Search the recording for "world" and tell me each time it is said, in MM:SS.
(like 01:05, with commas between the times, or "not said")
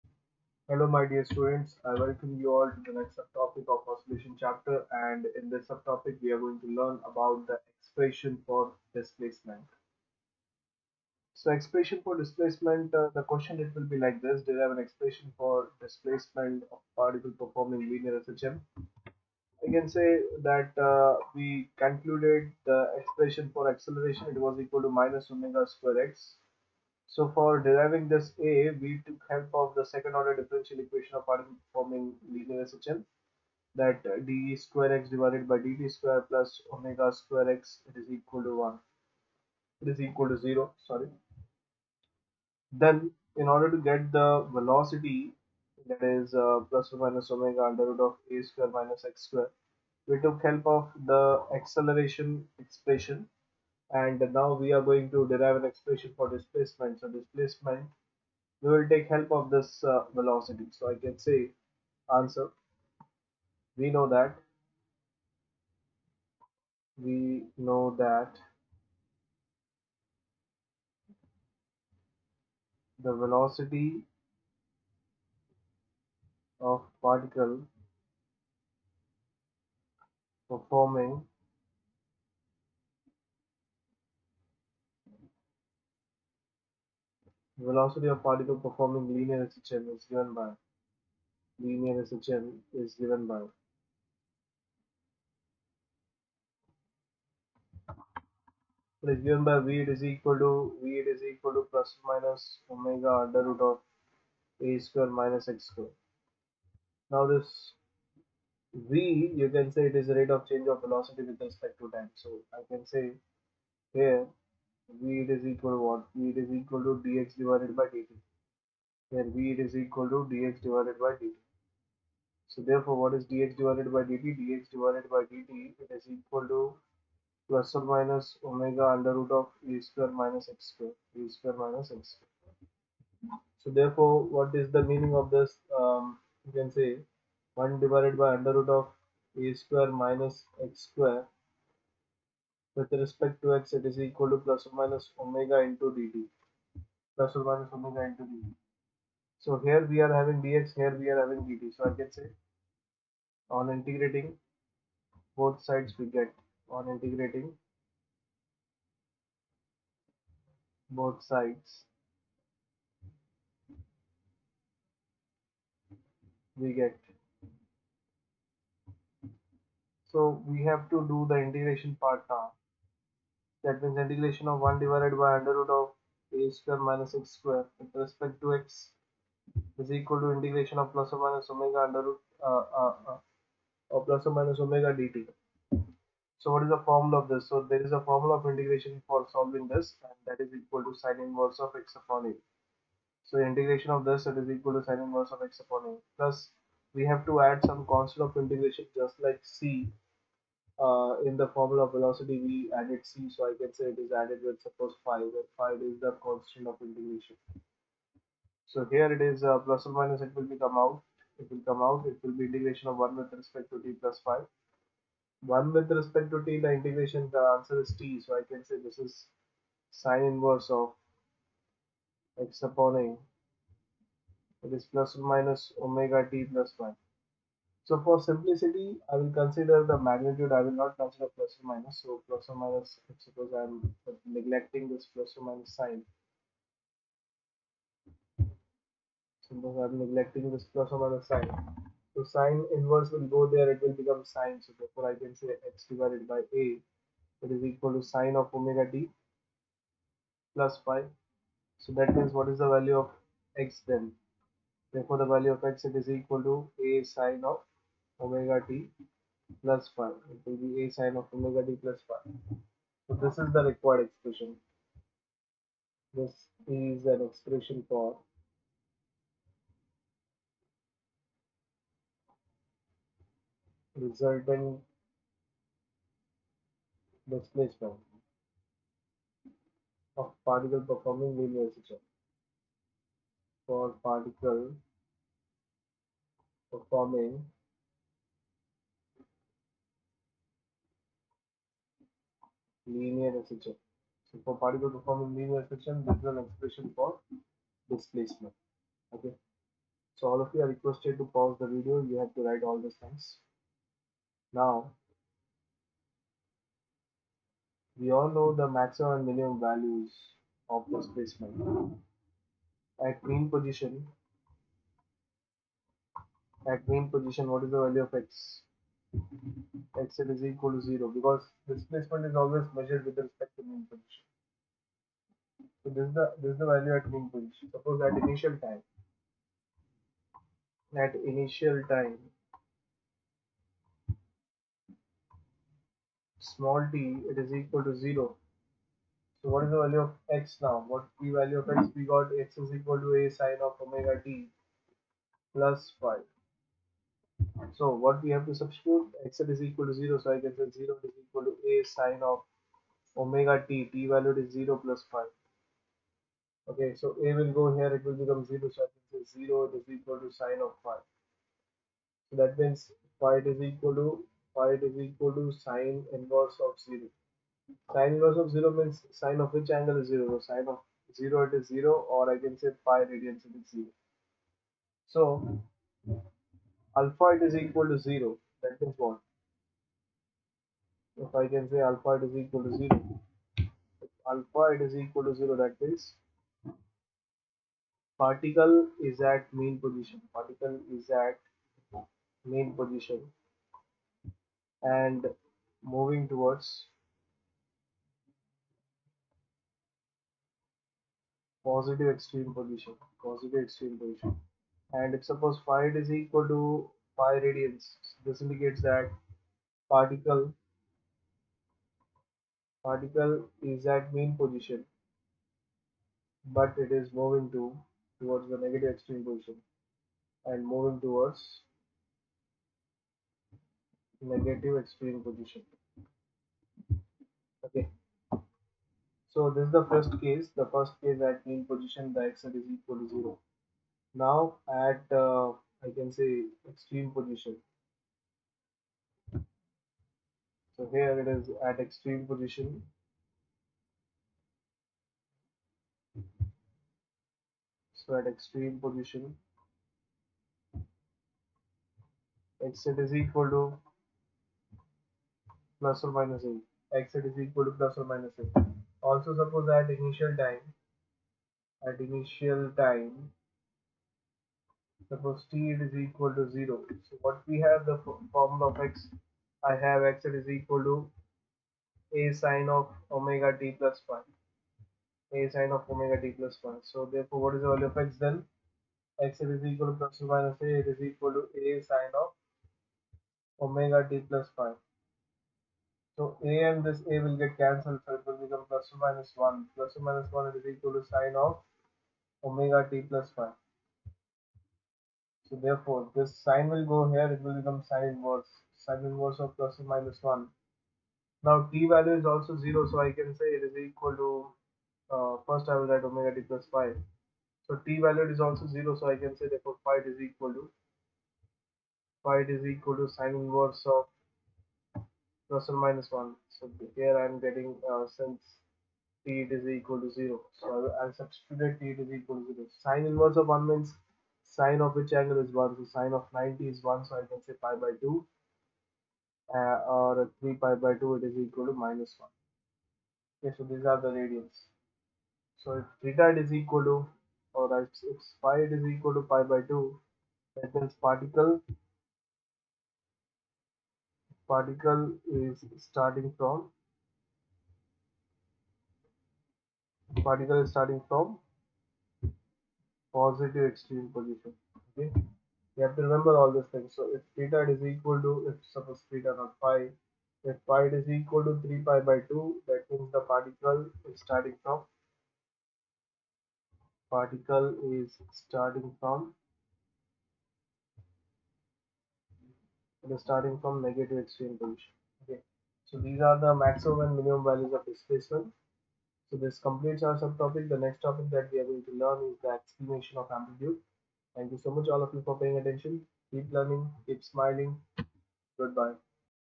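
not said.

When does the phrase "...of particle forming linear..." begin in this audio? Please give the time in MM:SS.
00:31.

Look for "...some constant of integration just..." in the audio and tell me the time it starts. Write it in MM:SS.
03:17.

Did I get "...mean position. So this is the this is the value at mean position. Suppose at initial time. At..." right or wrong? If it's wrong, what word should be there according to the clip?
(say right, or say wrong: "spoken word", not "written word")
right.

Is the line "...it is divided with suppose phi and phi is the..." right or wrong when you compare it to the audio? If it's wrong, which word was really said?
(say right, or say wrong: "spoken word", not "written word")
wrong: "added", not "divided".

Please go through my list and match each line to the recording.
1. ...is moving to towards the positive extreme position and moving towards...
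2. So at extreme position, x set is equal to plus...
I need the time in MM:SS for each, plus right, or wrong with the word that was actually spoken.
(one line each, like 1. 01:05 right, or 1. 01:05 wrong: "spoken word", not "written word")
1. 06:56 wrong: "negative", not "positive"
2. 07:28 right.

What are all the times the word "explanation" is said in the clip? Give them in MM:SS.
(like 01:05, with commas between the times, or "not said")
09:42.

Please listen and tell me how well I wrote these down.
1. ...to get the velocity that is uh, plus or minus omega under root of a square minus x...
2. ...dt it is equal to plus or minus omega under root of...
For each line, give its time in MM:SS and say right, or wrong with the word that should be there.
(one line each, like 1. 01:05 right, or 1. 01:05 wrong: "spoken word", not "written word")
1. 00:43 right
2. 02:05 right.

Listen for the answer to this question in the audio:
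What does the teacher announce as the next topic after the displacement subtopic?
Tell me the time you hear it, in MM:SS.
09:43.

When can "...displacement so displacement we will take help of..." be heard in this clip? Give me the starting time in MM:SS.
00:56.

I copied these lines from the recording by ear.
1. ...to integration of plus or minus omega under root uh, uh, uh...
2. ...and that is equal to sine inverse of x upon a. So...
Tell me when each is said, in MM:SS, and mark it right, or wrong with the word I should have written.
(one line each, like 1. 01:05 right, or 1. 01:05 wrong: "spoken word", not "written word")
1. 03:00 right
2. 03:10 right.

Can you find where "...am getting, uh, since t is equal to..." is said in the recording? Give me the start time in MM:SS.
08:37.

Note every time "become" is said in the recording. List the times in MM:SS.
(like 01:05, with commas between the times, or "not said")
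04:03, 05:58, 08:08, 08:17.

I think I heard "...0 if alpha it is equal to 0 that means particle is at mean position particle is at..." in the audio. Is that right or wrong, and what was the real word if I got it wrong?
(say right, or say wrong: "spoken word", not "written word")
right.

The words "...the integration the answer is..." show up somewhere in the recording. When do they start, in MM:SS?
03:36.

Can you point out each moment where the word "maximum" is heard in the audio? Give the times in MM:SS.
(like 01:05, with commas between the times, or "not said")
05:08, 09:36.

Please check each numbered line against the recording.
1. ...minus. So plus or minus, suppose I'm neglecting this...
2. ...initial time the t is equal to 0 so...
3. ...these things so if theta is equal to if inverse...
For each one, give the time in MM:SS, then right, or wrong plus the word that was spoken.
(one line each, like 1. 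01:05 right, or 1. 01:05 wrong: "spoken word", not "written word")
1. 03:51 right
2. 07:41 right
3. 09:16 wrong: "suppose", not "inverse".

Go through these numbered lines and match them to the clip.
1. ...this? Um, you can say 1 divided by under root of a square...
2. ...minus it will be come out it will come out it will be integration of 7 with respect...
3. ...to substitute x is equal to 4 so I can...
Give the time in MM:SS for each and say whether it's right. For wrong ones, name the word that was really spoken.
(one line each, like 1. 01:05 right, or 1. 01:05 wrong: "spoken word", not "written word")
1. 02:15 right
2. 03:29 wrong: "1", not "7"
3. 05:48 wrong: "0", not "4".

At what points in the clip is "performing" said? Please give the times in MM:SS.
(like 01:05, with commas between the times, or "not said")
00:17, 01:20, 01:28, 04:40, 04:46, 04:54.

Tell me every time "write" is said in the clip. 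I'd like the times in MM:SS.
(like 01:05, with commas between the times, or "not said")
05:02, 08:25.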